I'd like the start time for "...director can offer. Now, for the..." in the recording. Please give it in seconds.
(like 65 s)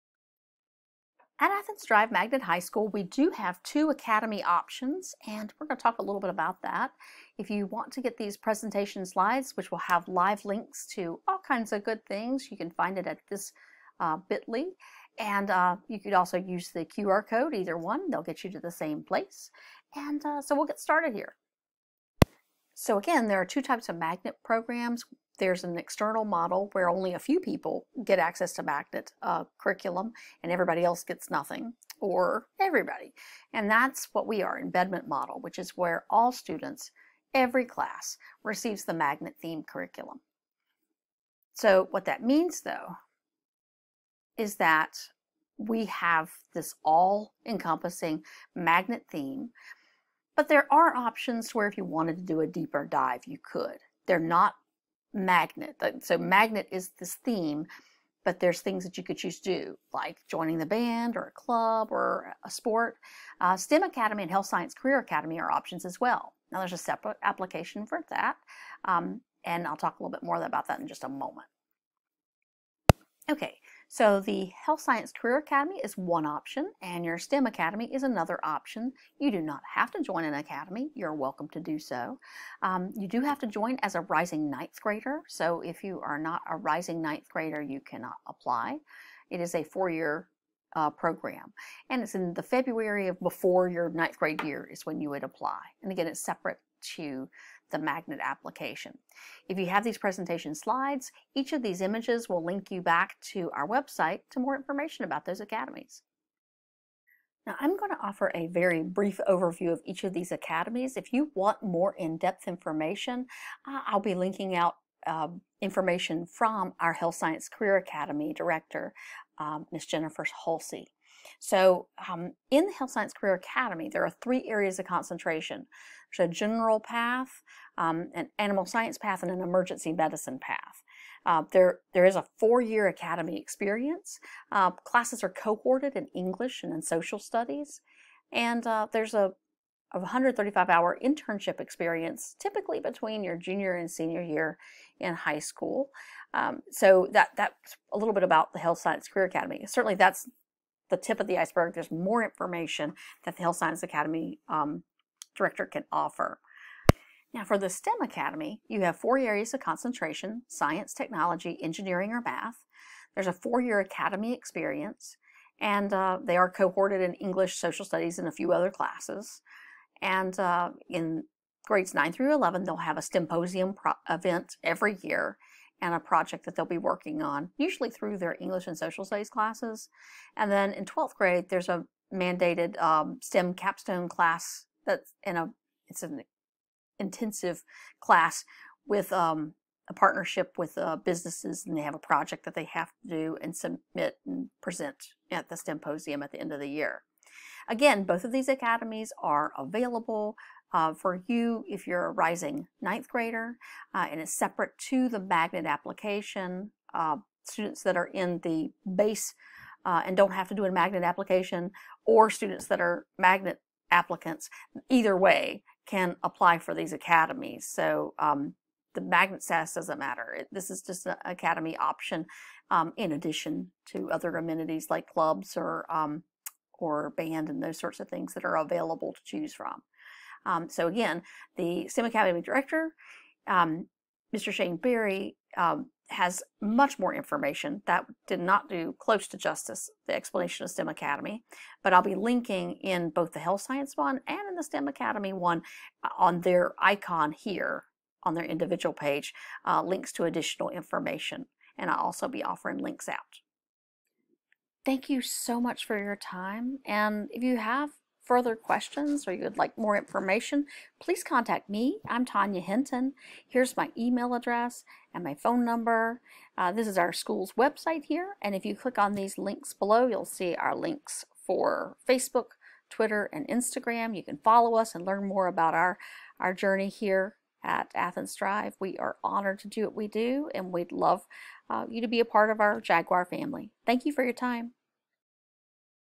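155 s.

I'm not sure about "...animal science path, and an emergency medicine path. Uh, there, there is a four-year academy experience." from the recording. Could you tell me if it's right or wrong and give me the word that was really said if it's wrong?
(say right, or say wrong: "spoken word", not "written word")
right.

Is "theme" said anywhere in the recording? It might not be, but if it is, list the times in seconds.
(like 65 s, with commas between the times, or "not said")
39 s, 49 s, 57 s.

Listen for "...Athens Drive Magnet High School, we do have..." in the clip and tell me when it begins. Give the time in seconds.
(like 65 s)
1 s.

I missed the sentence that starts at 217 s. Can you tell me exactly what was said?
So um, the magnet status doesn't matter.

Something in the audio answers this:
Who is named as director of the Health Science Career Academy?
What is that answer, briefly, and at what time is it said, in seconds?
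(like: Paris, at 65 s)
Jennifer Halsey, at 119 s.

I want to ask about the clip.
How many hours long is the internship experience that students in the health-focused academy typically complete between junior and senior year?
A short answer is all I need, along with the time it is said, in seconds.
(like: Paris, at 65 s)
135, at 139 s.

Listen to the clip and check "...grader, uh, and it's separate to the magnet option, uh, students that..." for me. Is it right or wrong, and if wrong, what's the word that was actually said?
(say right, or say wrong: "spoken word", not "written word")
wrong: "application", not "option".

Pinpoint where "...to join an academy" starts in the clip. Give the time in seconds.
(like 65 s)
79 s.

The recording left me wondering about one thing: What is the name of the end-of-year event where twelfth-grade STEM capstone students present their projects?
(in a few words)
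STEMposium.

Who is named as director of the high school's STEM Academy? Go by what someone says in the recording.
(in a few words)
Shane Berry.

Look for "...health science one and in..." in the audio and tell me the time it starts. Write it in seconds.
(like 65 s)
243 s.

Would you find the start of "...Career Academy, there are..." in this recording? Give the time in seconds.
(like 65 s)
123 s.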